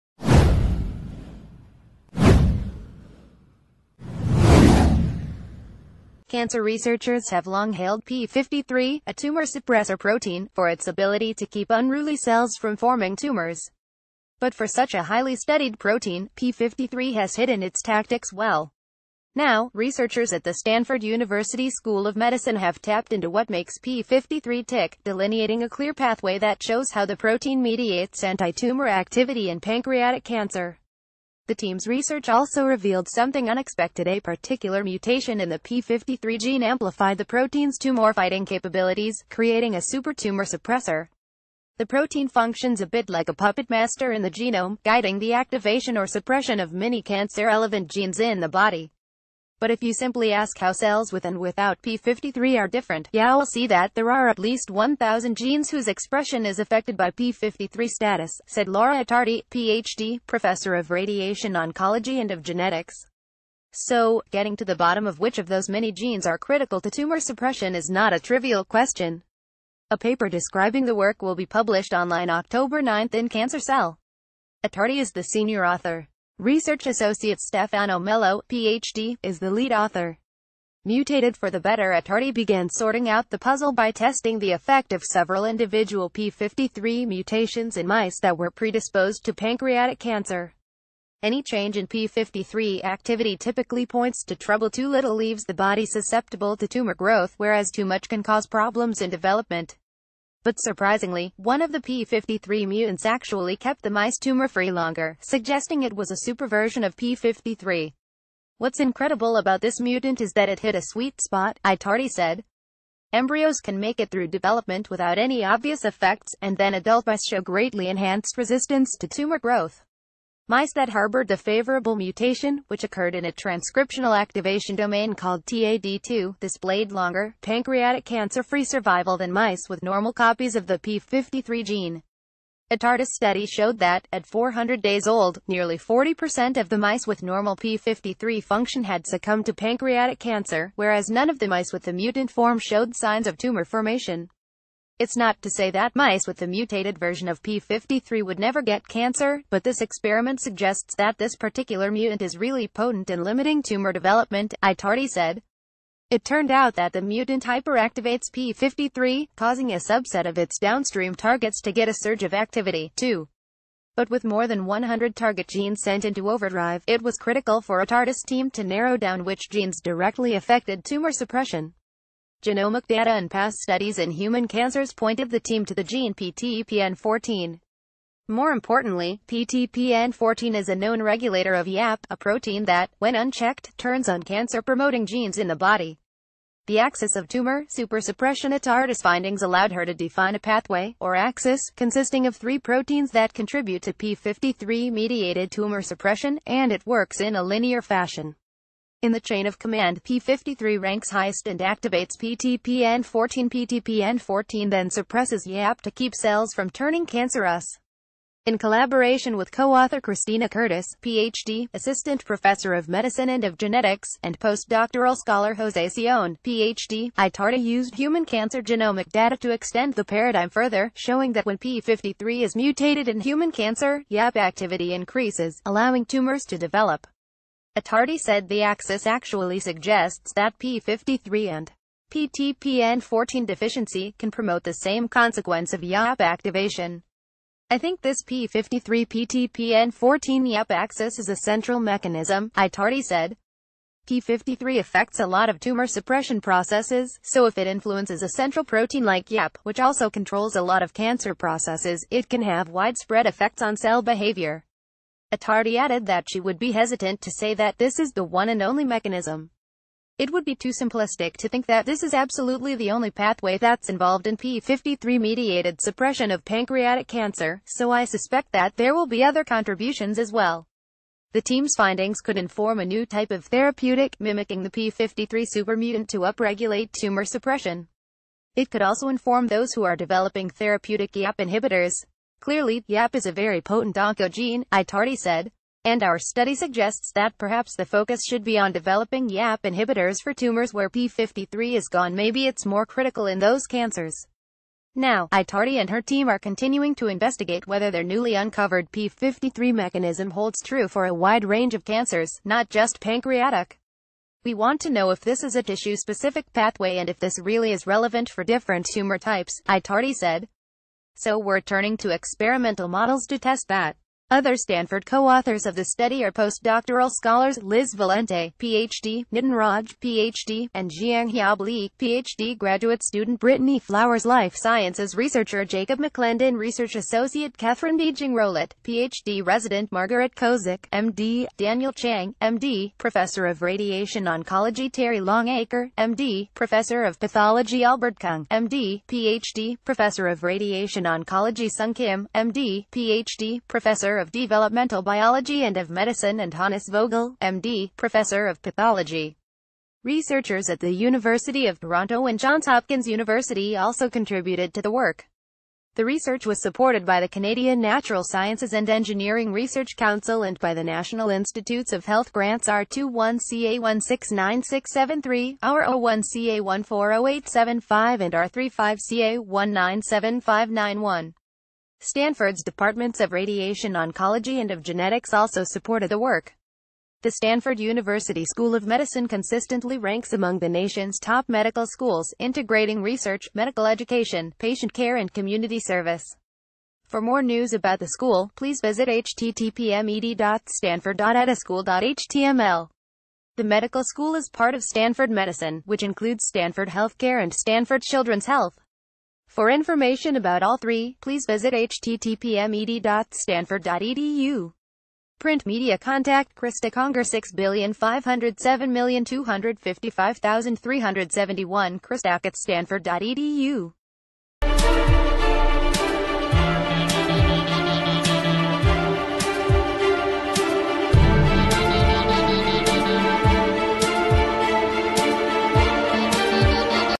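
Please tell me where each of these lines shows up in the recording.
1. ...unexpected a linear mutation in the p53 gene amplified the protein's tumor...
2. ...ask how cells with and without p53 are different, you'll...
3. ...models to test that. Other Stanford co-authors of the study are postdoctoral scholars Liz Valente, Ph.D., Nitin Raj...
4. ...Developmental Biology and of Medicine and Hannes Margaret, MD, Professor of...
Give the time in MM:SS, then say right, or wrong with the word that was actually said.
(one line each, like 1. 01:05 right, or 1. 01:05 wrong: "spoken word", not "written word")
1. 00:33 wrong: "particular", not "linear"
2. 00:50 right
3. 05:12 right
4. 05:44 wrong: "Vogel", not "Margaret".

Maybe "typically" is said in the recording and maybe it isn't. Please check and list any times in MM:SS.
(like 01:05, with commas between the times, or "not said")
01:33.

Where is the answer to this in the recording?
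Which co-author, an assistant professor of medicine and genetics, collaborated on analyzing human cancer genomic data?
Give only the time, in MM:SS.
03:30.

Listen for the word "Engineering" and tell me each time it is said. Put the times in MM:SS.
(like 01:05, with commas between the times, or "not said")
05:58.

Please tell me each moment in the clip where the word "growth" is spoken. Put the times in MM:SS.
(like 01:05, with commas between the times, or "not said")
01:36, 01:59.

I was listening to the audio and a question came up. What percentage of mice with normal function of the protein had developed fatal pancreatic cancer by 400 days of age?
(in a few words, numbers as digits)
40%.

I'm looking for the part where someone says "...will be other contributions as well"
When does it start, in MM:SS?
04:28.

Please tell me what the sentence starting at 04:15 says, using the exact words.
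Attardi added that she would be hesitant to say that this is the one and only mechanism.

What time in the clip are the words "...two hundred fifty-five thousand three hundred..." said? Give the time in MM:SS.
06:49.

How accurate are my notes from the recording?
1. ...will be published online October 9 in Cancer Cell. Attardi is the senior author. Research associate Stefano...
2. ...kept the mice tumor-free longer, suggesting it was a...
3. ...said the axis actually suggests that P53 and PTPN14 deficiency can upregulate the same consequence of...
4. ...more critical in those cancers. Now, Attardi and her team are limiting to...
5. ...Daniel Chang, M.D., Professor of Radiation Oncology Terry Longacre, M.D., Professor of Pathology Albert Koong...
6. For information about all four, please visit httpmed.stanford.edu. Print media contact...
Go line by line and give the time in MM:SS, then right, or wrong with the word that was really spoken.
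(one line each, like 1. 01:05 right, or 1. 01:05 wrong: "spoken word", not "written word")
1. 01:11 right
2. 01:43 right
3. 03:48 wrong: "promote", not "upregulate"
4. 04:52 wrong: "continuing", not "limiting"
5. 05:31 right
6. 06:39 wrong: "three", not "four".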